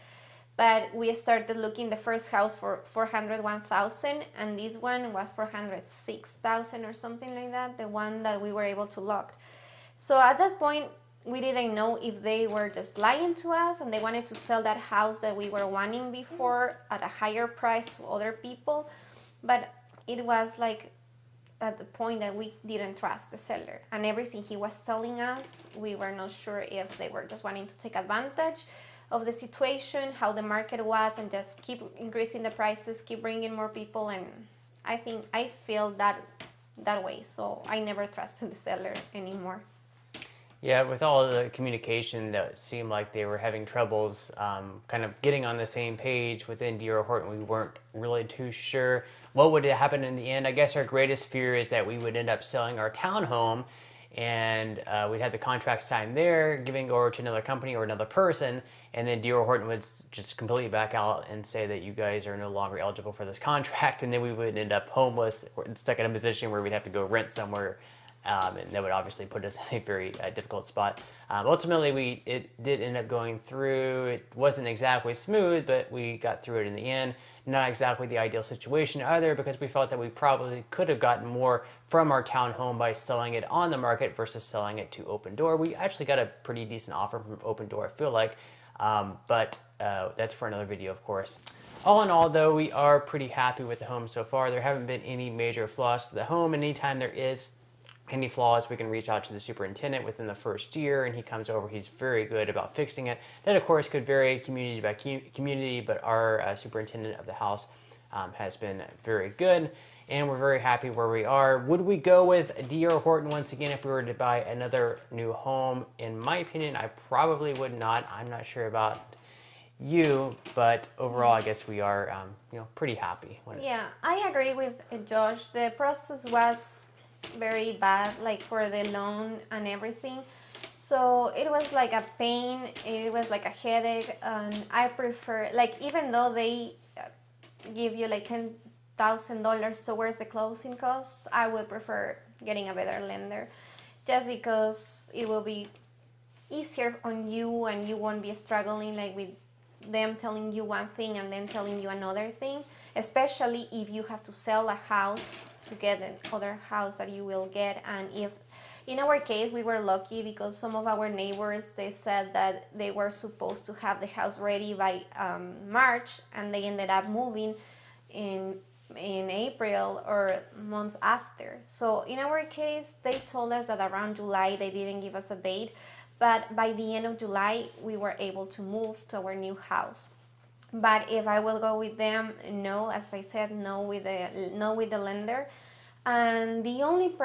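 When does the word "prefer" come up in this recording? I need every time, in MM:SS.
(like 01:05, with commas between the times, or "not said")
02:14, 02:21.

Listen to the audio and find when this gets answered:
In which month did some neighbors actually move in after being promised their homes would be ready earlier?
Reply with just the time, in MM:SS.
02:49.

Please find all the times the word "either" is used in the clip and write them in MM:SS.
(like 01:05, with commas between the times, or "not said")
01:19.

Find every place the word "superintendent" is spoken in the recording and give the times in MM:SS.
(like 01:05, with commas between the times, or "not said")
01:39, 01:46.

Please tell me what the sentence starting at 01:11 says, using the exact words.
Um, ultimately, we it did end up going through.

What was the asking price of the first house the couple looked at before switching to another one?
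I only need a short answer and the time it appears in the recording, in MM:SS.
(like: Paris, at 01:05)
401,000, at 00:02.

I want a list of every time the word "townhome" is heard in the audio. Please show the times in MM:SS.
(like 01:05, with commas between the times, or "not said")
00:52, 01:22.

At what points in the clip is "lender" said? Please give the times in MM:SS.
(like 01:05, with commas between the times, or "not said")
02:23, 03:04.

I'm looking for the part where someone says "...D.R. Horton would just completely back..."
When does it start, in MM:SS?
00:59.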